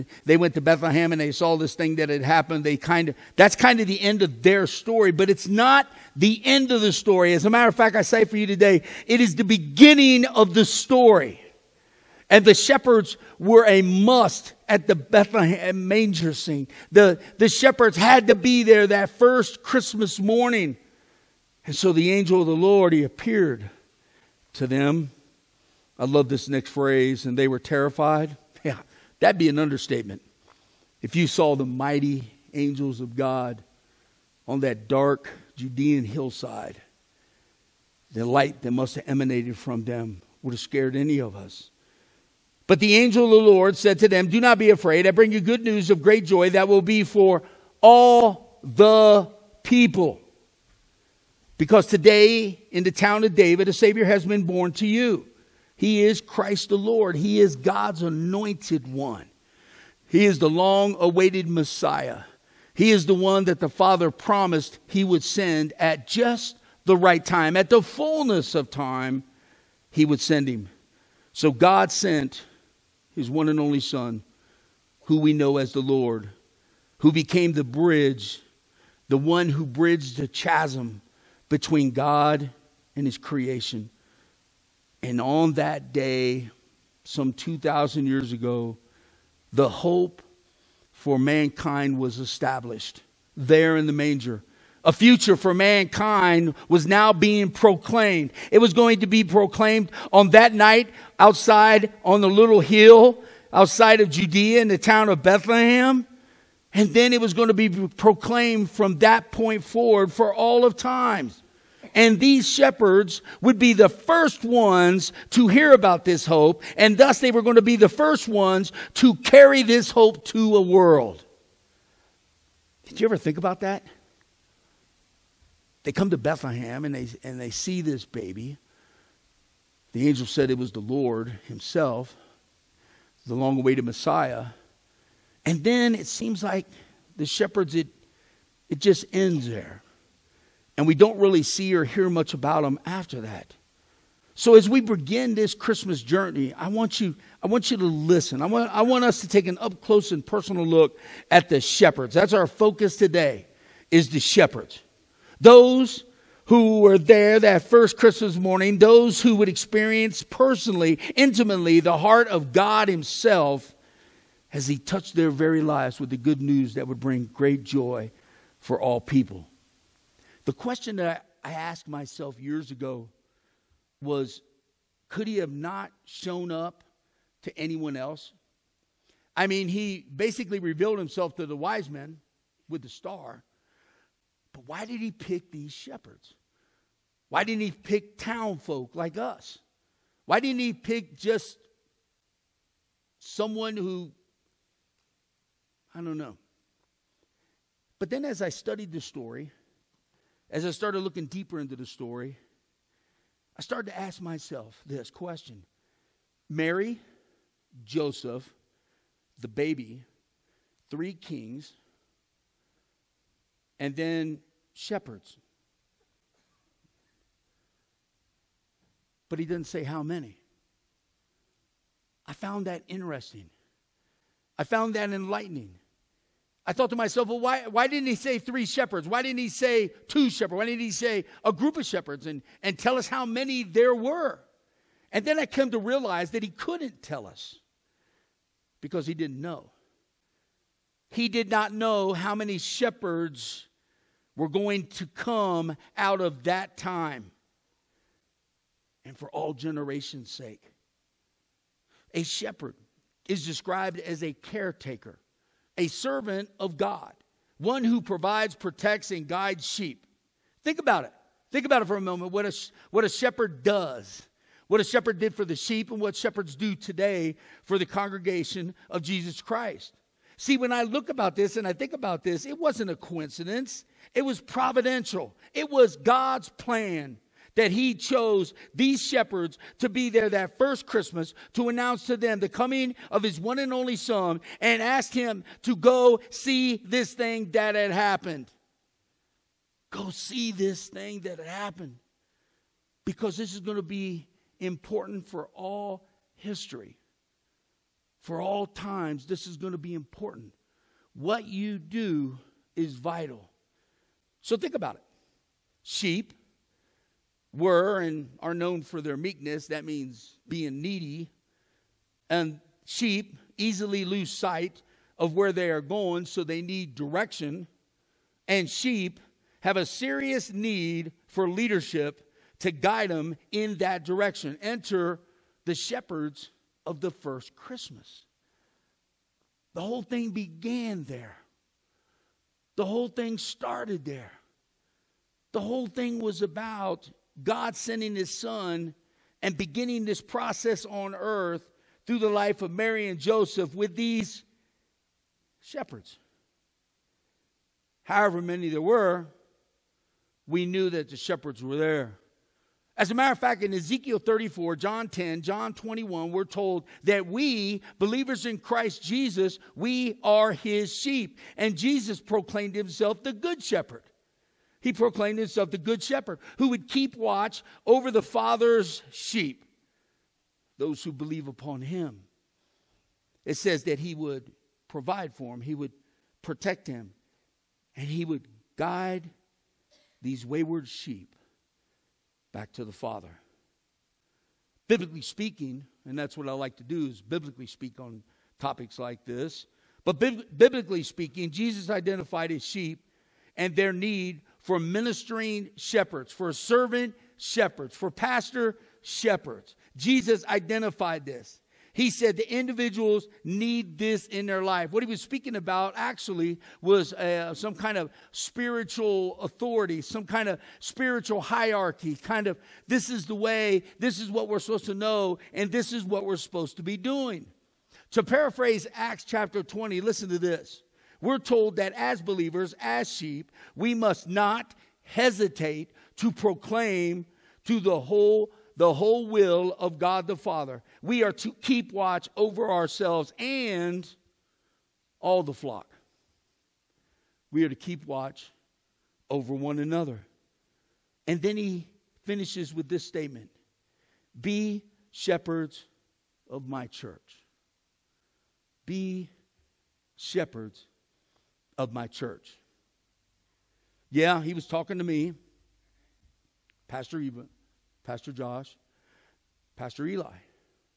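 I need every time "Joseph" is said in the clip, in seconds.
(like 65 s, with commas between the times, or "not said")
207 s, 343 s.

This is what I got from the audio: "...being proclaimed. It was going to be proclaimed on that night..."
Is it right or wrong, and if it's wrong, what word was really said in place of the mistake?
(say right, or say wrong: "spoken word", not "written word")
right.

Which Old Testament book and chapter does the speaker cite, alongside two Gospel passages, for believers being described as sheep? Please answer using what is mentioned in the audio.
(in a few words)
Ezekiel 34.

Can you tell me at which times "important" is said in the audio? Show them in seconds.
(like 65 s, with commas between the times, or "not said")
294 s, 299 s.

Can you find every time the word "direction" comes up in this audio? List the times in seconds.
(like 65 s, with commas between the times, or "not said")
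316 s, 324 s.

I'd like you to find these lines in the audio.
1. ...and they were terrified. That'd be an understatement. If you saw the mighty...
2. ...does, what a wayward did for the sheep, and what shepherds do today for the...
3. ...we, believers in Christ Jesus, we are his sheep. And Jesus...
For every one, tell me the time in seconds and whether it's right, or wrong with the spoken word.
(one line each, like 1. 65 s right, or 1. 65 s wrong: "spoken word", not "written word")
1. 27 s right
2. 263 s wrong: "shepherd", not "wayward"
3. 357 s right.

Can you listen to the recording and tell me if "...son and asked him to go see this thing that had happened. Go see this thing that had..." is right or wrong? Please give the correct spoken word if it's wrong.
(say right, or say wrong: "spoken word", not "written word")
right.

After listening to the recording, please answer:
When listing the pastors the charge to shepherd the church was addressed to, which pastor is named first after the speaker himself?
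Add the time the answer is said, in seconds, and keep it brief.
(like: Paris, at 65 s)
Pastor Eva, at 456 s.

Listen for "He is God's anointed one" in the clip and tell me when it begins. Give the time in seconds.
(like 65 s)
57 s.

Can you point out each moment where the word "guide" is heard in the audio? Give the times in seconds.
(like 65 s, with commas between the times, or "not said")
259 s, 322 s, 378 s.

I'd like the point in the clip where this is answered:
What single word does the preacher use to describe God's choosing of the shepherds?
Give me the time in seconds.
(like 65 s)
274 s.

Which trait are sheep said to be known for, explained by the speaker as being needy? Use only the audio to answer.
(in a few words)
Meekness.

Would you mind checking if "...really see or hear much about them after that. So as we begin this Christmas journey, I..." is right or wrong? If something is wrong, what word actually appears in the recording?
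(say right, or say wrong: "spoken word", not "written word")
right.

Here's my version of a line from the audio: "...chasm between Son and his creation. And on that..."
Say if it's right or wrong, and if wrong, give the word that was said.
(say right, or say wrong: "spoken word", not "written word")
wrong: "God", not "Son".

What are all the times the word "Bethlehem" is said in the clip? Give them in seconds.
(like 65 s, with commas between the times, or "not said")
0 s, 14 s, 105 s, 126 s.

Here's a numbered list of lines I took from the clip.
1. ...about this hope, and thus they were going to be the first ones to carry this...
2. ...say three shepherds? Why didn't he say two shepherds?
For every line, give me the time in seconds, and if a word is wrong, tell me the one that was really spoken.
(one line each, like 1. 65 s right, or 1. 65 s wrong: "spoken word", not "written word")
1. 115 s right
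2. 228 s right.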